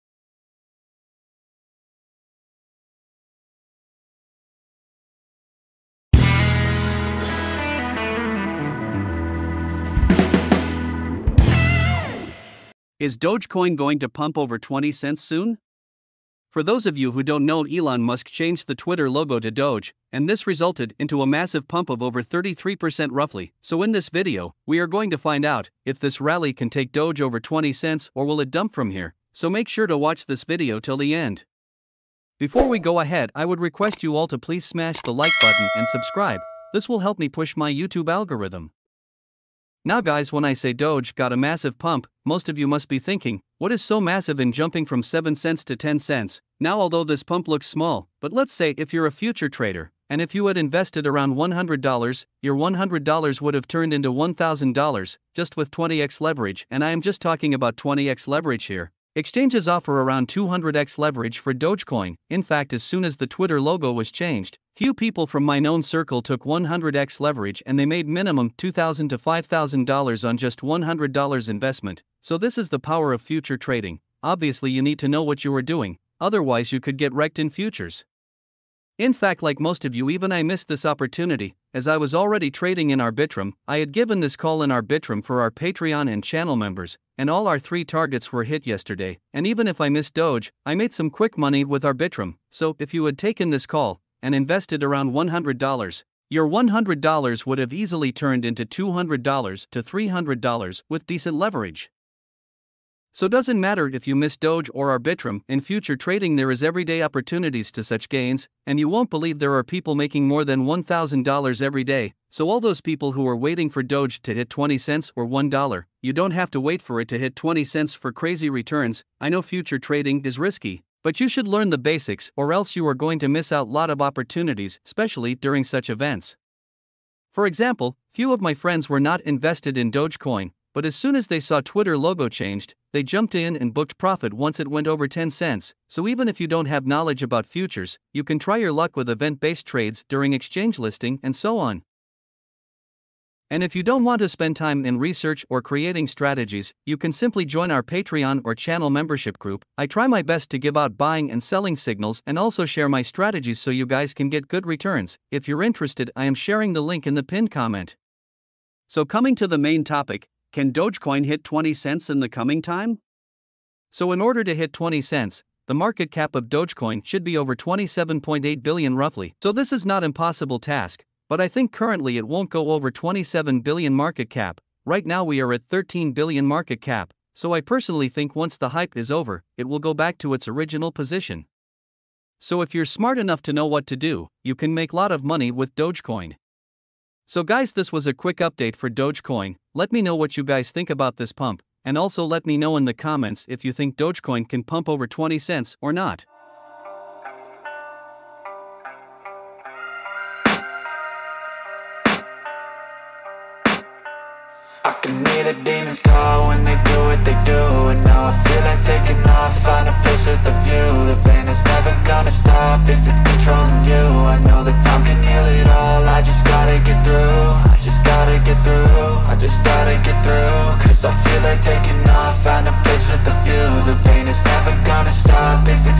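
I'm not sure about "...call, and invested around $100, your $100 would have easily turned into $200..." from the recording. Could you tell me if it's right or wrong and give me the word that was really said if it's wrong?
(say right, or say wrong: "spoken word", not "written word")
right.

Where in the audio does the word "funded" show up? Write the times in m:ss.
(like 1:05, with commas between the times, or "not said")
not said.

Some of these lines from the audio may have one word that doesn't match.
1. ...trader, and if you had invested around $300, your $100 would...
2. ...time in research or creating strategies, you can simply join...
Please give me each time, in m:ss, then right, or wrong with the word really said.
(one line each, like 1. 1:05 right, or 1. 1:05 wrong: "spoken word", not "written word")
1. 0:49 wrong: "100", not "300"
2. 2:24 right.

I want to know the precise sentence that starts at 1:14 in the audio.
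Obviously, you need to know what you are doing, otherwise, you could get wrecked in futures.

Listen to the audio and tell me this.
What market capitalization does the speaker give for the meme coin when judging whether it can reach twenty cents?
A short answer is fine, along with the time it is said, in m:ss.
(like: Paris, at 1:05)
13 billion, at 2:55.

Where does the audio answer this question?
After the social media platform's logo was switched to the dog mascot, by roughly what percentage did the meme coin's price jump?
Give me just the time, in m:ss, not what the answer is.
0:22.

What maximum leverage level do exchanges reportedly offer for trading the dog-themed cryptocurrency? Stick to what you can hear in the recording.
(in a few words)
200x.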